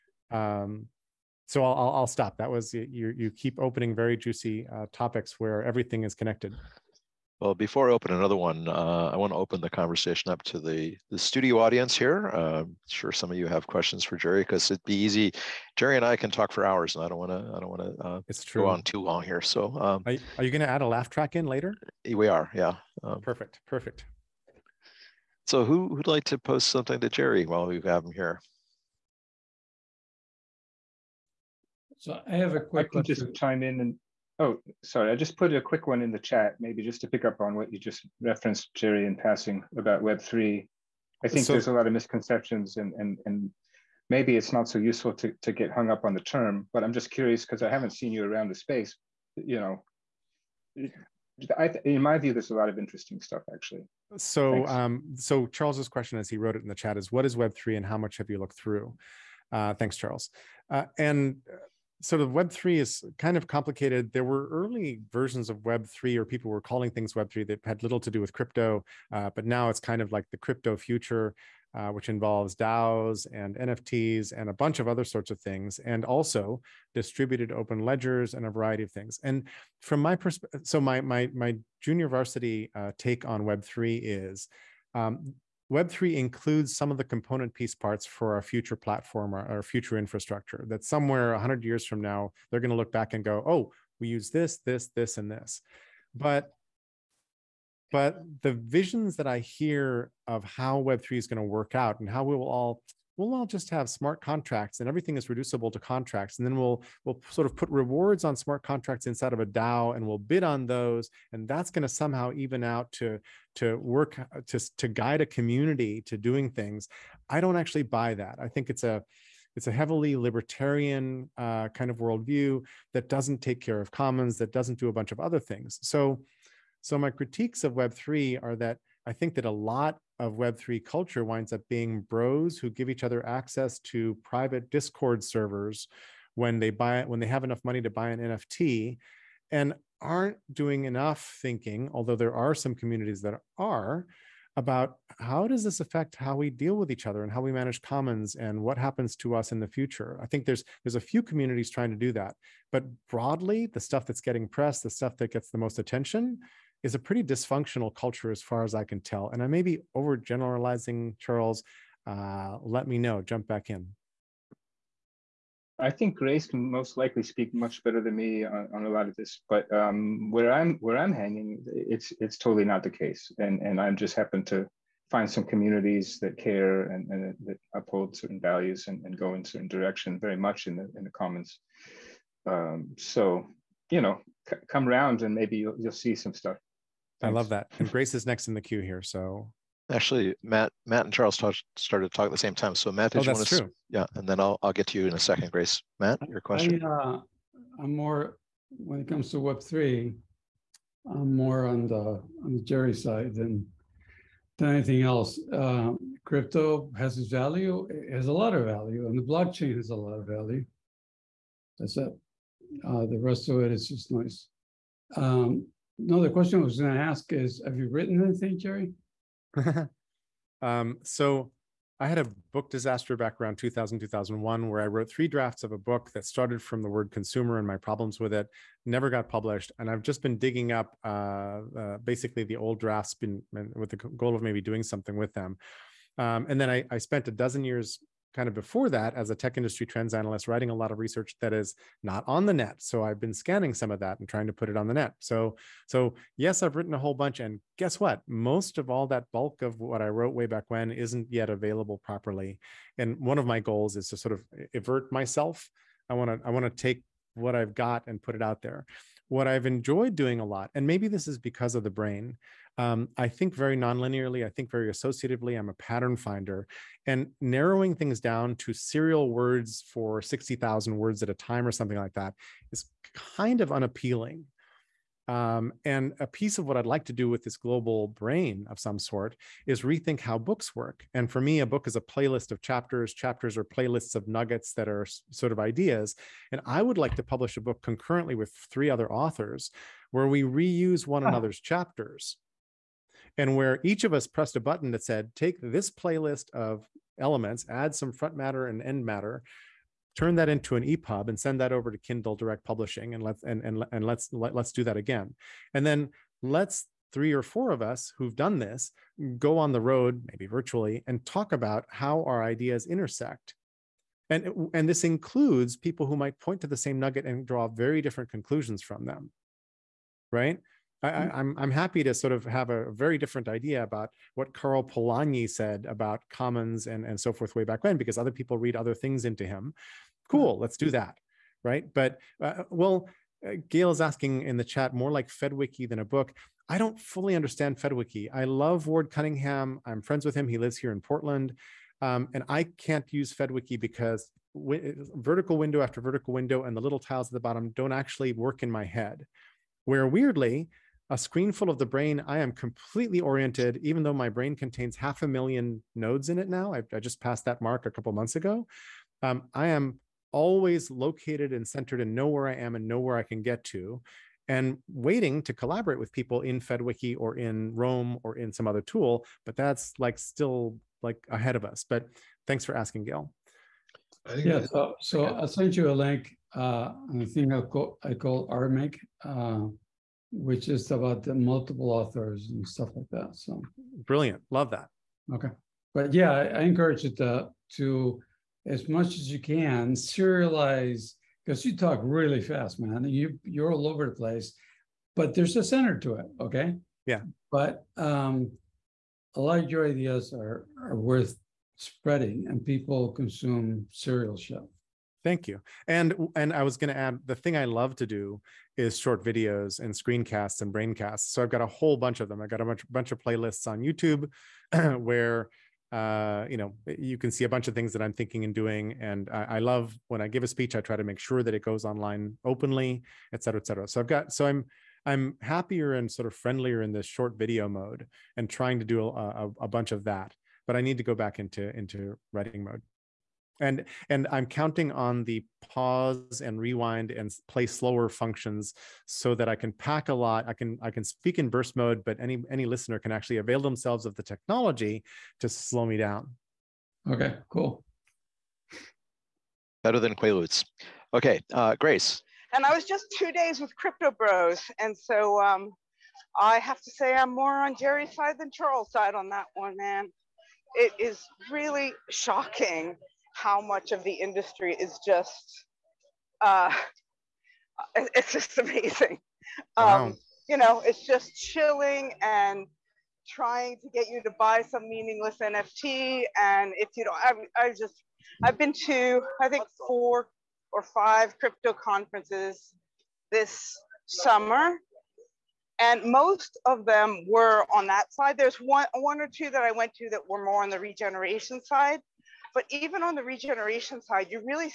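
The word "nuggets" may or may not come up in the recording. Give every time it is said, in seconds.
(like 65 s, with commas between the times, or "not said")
284 s, 316 s.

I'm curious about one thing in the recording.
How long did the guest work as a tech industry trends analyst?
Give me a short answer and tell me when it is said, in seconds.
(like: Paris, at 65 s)
a dozen, at 237 s.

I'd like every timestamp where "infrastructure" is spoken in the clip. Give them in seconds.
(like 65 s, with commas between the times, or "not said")
89 s.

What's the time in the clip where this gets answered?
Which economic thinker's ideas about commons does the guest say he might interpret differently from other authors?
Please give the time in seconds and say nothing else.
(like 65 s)
324 s.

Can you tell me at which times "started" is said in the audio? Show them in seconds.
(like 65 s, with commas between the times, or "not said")
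191 s, 226 s.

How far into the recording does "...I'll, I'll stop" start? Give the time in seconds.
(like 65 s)
1 s.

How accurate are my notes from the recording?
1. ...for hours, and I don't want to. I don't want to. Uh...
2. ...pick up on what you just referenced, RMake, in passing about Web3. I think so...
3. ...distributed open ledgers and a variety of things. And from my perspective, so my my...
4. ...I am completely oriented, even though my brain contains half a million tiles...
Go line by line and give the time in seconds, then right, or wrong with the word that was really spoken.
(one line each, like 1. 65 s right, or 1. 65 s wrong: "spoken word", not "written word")
1. 16 s right
2. 37 s wrong: "Jerry", not "RMake"
3. 76 s right
4. 352 s wrong: "nodes", not "tiles".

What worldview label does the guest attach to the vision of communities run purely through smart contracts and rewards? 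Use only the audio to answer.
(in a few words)
libertarian.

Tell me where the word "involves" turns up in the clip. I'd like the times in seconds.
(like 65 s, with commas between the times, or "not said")
72 s.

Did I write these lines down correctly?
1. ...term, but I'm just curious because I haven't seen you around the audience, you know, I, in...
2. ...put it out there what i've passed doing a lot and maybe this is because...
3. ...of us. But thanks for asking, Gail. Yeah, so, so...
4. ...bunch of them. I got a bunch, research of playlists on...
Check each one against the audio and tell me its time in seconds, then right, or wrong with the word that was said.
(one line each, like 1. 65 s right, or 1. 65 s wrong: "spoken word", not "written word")
1. 46 s wrong: "space", not "audience"
2. 258 s wrong: "enjoyed", not "passed"
3. 371 s right
4. 411 s wrong: "bunch", not "research".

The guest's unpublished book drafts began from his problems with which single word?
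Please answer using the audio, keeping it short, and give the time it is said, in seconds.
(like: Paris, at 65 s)
consumer, at 227 s.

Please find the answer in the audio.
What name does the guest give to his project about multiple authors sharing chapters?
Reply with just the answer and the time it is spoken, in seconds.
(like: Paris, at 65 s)
RMake, at 378 s.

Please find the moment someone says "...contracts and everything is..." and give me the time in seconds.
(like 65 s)
104 s.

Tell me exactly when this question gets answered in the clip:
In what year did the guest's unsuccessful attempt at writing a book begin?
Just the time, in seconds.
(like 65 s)
223 s.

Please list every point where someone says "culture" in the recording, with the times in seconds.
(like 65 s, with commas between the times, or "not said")
130 s, 157 s.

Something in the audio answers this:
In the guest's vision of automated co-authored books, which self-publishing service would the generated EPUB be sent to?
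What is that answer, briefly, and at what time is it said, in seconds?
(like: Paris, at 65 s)
Kindle Direct Publishing, at 301 s.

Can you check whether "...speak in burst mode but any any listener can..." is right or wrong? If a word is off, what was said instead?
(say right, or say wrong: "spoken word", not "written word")
right.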